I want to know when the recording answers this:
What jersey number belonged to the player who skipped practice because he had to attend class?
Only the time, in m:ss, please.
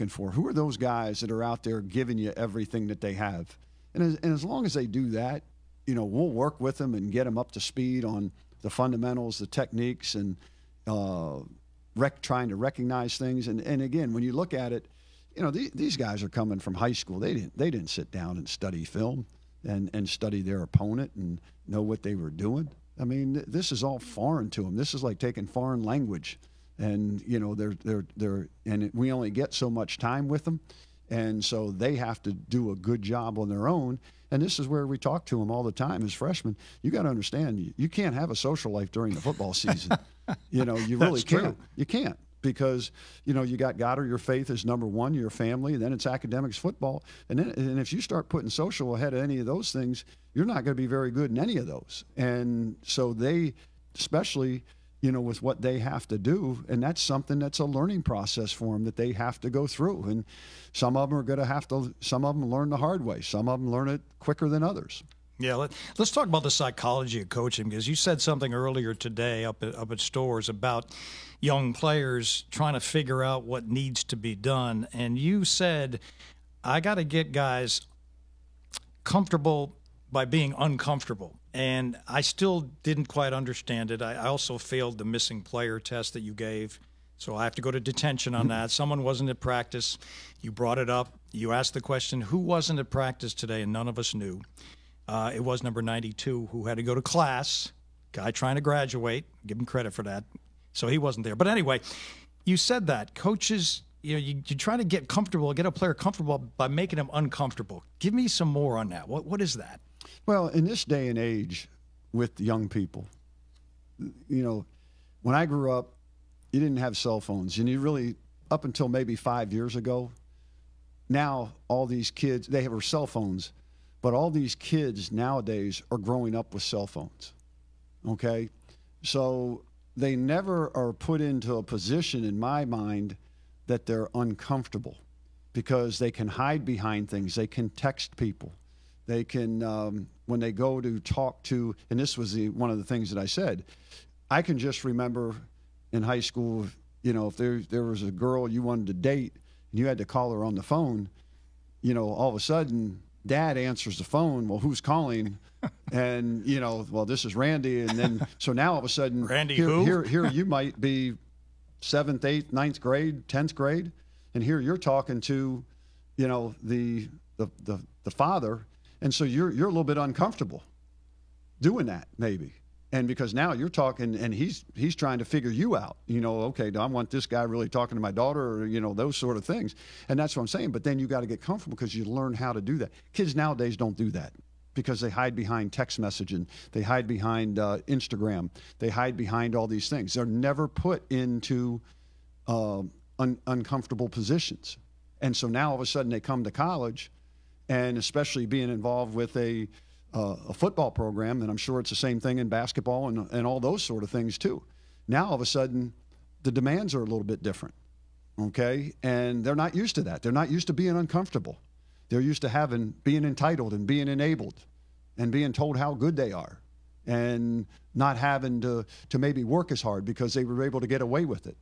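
1:35.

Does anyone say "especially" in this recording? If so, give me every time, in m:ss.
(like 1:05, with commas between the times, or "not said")
0:53, 3:17.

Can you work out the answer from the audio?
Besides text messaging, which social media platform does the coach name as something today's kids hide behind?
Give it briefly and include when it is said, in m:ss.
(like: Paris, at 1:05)
Instagram, at 3:07.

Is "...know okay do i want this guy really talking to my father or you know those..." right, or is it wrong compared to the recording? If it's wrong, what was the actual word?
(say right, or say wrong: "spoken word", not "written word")
wrong: "daughter", not "father".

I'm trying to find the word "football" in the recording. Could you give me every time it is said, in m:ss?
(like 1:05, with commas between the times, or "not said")
0:39, 0:46, 3:20.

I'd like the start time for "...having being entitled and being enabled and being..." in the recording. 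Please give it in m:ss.
3:32.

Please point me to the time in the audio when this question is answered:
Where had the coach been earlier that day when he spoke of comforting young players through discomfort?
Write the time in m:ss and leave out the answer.
1:10.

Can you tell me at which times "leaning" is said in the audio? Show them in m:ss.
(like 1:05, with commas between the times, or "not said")
not said.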